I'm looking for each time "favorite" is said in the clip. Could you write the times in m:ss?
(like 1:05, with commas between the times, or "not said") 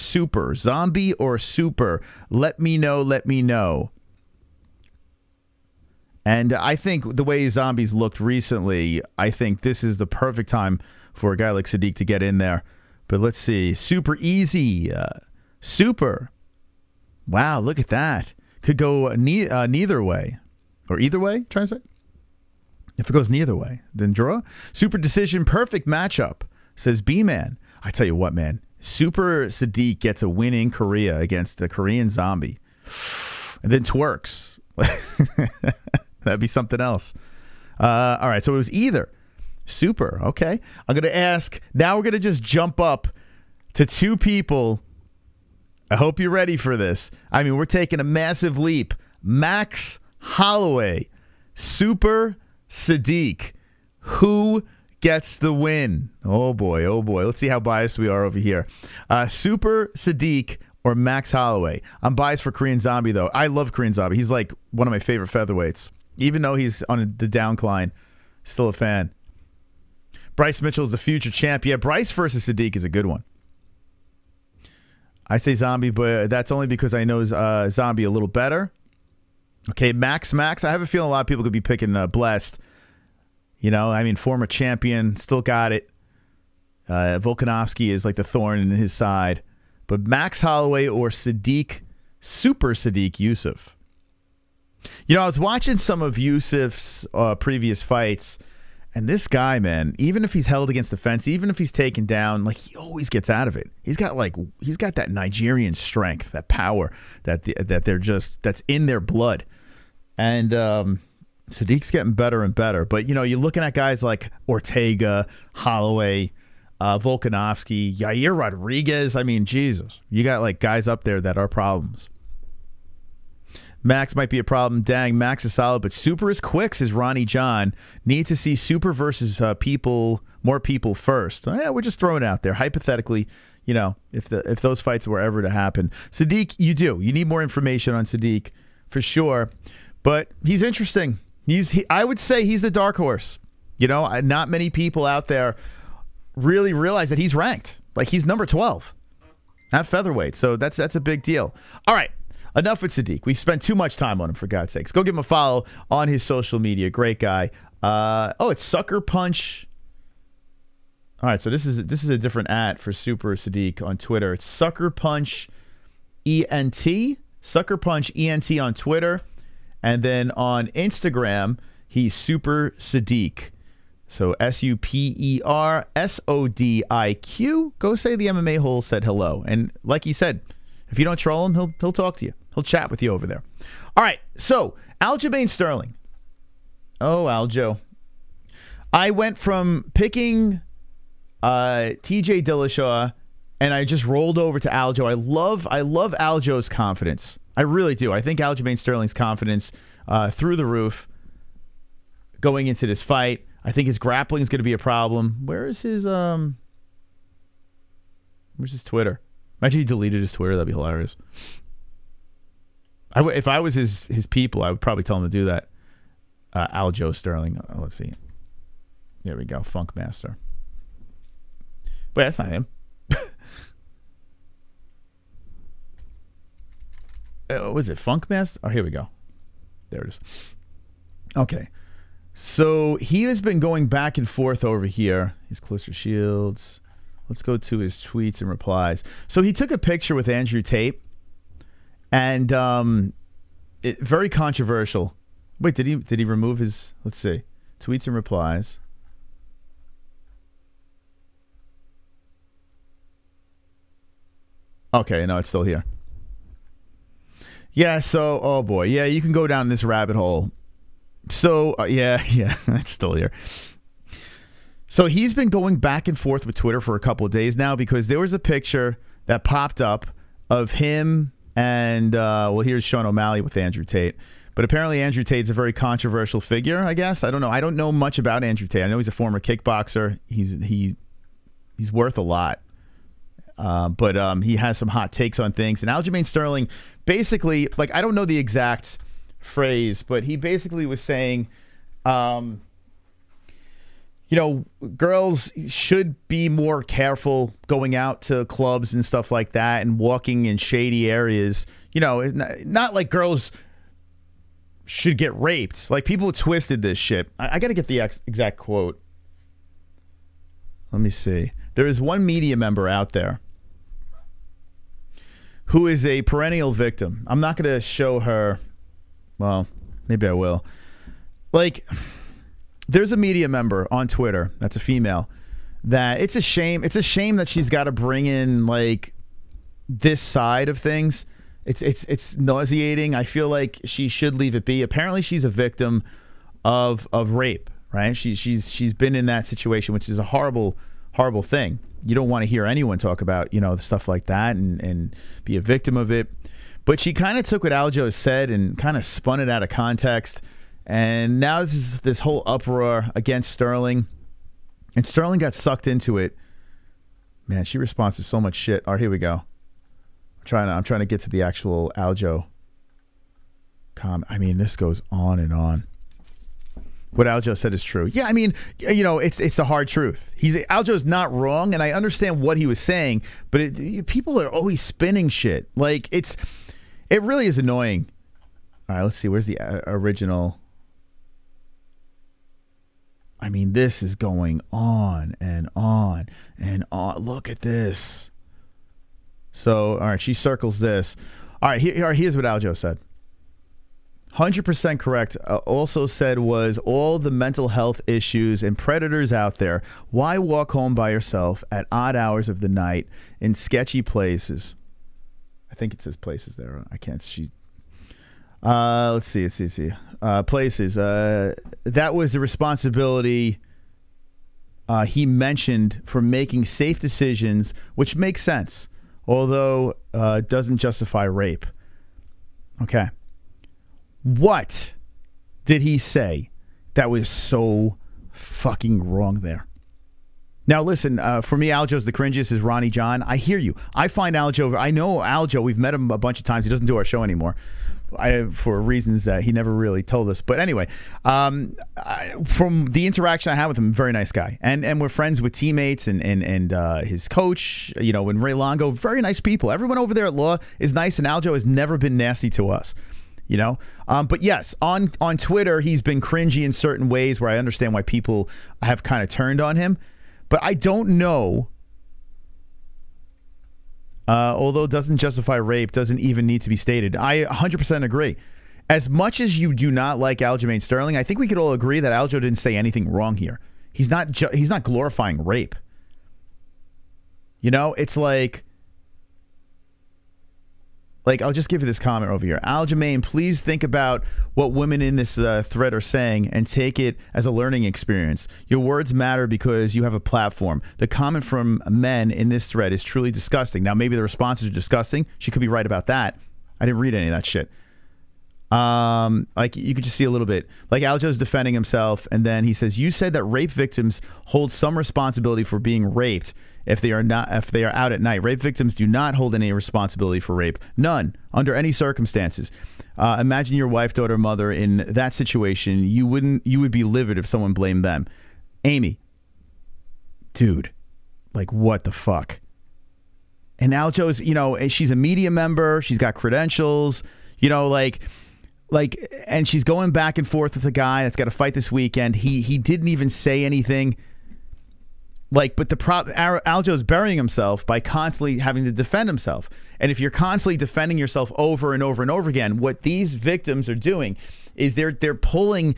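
1:04.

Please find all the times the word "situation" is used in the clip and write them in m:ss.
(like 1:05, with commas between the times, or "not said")
5:39, 8:35.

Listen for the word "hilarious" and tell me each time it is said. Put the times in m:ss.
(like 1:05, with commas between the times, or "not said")
3:30.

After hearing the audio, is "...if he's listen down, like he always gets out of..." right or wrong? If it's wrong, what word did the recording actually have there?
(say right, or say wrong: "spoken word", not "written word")
wrong: "taken", not "listen".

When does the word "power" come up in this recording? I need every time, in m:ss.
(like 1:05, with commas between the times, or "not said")
1:46.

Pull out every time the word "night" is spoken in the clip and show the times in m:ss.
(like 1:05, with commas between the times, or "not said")
6:42, 8:28.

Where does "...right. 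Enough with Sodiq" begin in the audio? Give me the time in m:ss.
2:31.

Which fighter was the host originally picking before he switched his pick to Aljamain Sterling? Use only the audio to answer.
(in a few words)
T.J. Dillashaw.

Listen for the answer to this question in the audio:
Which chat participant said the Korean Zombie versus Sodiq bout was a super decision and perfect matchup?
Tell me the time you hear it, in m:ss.
0:27.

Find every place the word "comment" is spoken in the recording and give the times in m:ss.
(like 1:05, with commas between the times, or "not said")
8:01, 8:11.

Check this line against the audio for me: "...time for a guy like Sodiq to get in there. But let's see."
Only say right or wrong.
right.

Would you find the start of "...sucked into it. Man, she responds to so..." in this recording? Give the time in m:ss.
5:55.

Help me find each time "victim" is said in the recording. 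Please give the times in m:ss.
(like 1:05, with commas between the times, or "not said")
5:16, 5:35, 5:45, 8:23, 8:28, 9:03.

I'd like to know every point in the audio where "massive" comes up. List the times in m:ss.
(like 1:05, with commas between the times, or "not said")
0:48.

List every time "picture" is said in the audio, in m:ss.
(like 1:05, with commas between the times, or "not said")
3:59, 4:28.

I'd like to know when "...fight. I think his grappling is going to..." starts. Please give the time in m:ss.
3:23.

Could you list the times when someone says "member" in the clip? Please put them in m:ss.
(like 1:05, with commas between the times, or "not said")
5:12, 5:23, 8:45.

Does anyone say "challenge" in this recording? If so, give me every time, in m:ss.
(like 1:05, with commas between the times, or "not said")
not said.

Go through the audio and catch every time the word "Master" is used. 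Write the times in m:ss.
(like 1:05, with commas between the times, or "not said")
3:39, 3:48.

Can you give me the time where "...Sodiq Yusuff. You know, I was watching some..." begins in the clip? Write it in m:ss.
1:32.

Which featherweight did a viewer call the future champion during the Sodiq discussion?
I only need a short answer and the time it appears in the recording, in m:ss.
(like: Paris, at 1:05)
Bryce Mitchell, at 1:10.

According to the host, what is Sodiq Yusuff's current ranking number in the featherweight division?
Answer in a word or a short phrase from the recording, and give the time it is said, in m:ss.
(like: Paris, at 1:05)
12, at 2:28.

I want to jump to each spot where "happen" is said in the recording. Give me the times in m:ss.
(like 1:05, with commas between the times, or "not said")
2:15.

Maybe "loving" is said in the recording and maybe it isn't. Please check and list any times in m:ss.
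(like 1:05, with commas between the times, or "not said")
not said.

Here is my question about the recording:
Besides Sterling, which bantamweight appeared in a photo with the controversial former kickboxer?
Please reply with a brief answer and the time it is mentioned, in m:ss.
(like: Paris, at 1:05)
Sean O'Malley, at 4:32.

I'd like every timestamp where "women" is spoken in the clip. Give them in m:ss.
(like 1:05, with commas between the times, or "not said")
8:04.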